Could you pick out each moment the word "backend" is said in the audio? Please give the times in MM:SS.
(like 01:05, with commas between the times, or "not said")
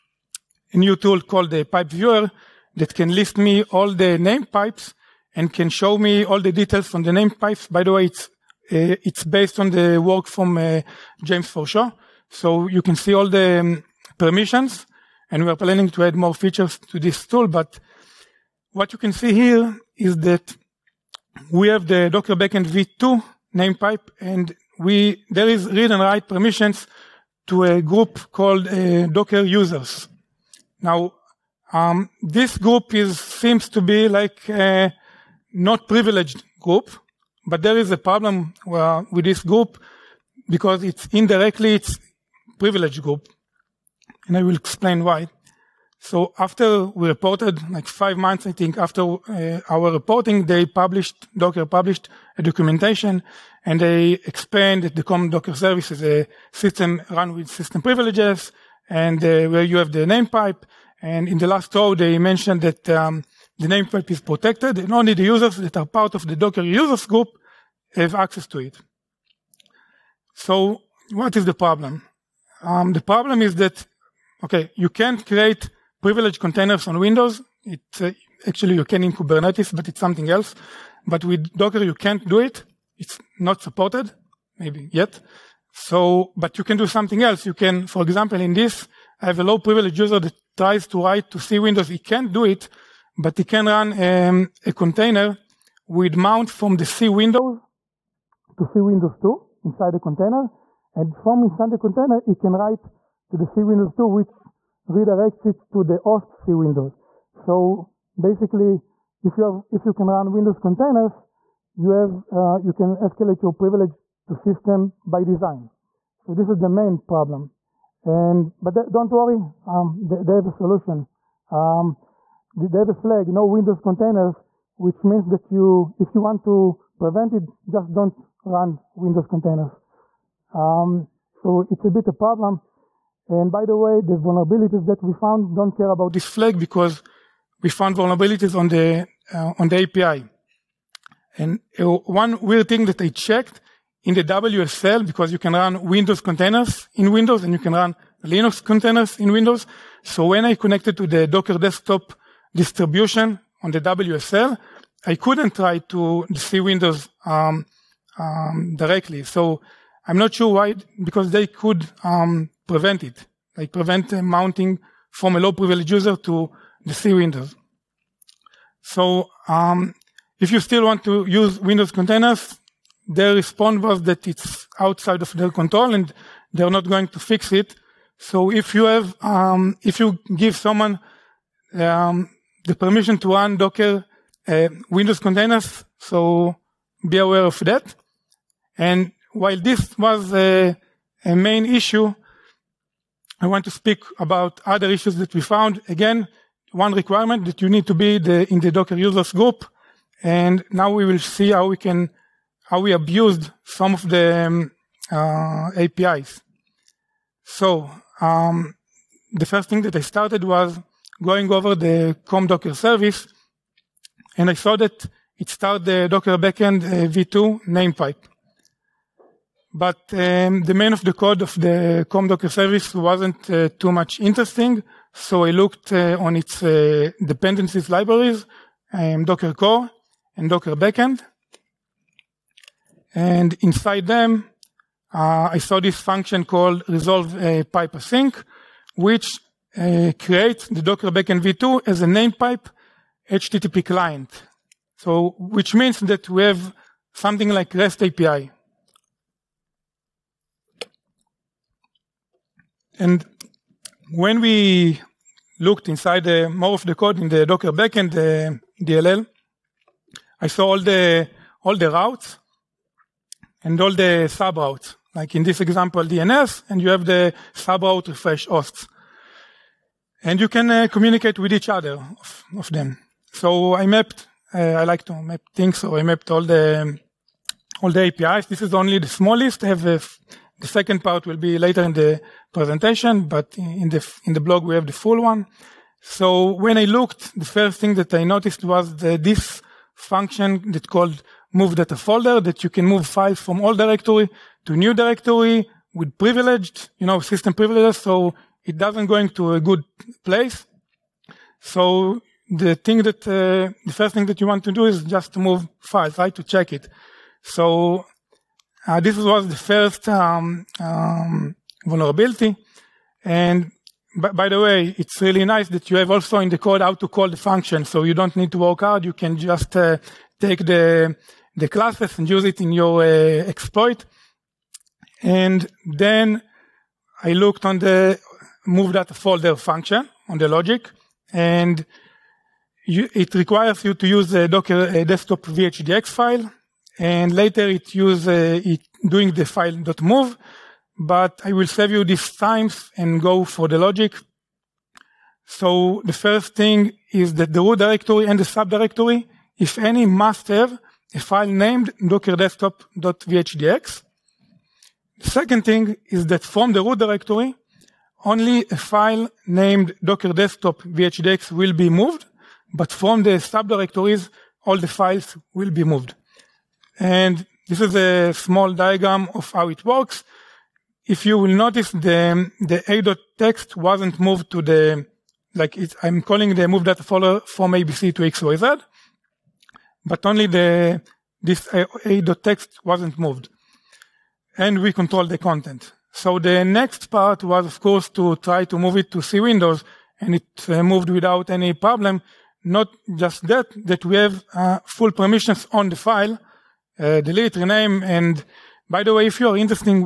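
00:22, 03:36, 03:50, 04:01, 04:17.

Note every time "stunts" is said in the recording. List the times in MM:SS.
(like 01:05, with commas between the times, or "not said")
not said.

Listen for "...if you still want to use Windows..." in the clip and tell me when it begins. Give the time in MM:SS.
02:50.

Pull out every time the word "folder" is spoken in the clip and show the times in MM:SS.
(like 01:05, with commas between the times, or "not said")
04:51, 05:29, 06:17.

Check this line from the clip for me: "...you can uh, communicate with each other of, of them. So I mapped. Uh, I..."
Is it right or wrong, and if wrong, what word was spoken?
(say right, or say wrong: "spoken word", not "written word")
right.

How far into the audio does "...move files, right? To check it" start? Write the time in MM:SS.
05:05.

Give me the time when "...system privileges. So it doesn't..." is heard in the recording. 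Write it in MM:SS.
04:57.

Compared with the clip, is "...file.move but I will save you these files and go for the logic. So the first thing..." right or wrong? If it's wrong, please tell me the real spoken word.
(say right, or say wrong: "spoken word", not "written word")
wrong: "times", not "files".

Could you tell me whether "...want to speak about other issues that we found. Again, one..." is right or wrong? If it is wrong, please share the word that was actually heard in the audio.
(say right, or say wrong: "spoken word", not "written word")
right.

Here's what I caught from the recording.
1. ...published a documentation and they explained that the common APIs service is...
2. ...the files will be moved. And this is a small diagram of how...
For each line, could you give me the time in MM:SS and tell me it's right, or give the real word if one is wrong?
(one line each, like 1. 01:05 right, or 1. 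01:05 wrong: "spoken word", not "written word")
1. 00:51 wrong: "Docker", not "APIs"
2. 06:04 right.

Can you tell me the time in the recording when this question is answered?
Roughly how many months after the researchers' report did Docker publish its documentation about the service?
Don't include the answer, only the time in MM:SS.
00:47.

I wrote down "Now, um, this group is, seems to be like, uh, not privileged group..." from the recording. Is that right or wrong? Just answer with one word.
right.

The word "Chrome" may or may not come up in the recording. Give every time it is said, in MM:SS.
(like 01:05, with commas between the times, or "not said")
03:32, 03:42.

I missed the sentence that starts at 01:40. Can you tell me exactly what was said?
And from inside the container, it can write to the C Windows 2, which redirects it to the host C Windows.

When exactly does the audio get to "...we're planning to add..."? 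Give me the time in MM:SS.
00:15.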